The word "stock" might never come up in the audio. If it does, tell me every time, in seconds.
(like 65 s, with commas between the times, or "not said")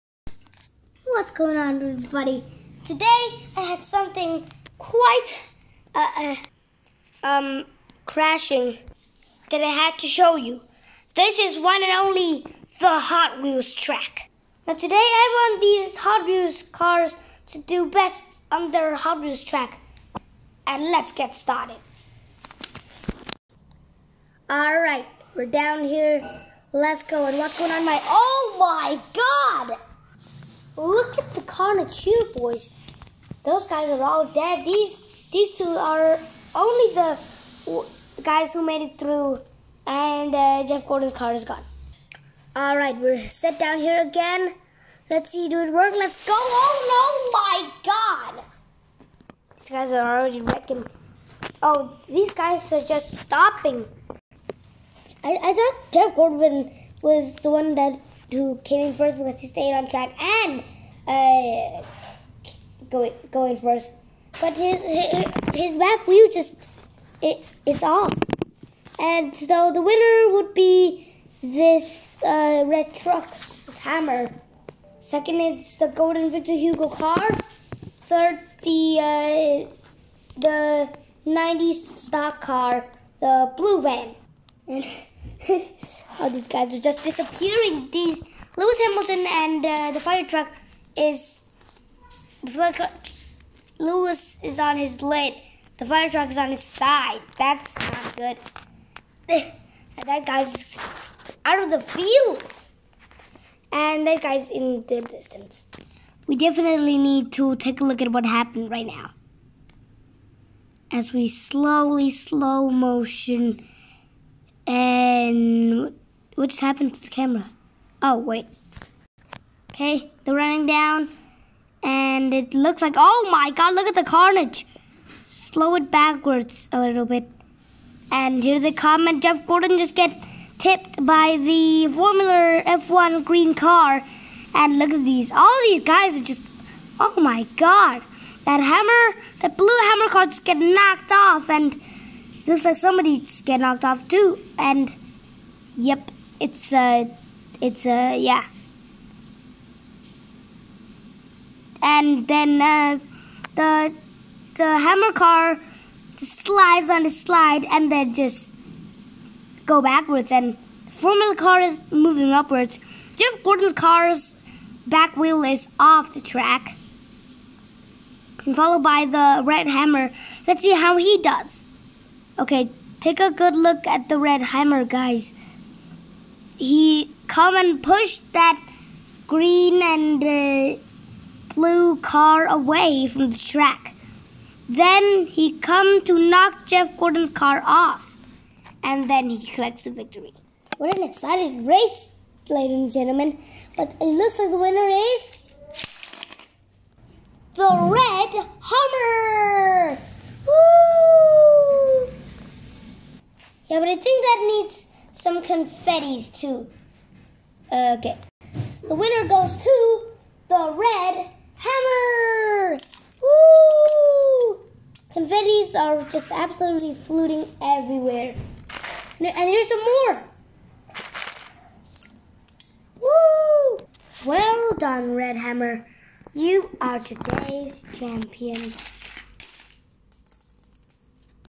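81 s.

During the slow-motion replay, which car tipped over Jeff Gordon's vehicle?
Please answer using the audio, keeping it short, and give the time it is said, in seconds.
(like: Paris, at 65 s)
Formula F1 green car, at 131 s.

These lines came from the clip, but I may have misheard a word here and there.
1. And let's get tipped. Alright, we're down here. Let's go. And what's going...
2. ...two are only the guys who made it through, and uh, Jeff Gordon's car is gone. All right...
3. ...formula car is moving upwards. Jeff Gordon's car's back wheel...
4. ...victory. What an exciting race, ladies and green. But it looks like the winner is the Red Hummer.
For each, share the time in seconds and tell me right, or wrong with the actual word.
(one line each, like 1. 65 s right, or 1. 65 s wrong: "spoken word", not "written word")
1. 20 s wrong: "started", not "tipped"
2. 35 s right
3. 160 s right
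4. 189 s wrong: "gentlemen", not "green".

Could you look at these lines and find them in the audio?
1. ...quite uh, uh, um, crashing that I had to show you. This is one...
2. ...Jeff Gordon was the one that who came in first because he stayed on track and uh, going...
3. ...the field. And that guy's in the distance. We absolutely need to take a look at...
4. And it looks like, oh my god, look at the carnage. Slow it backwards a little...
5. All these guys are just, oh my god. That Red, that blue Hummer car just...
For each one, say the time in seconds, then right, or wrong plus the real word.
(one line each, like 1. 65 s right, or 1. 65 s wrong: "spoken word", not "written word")
1. 4 s right
2. 55 s right
3. 101 s wrong: "definitely", not "absolutely"
4. 121 s right
5. 135 s wrong: "Hummer", not "Red".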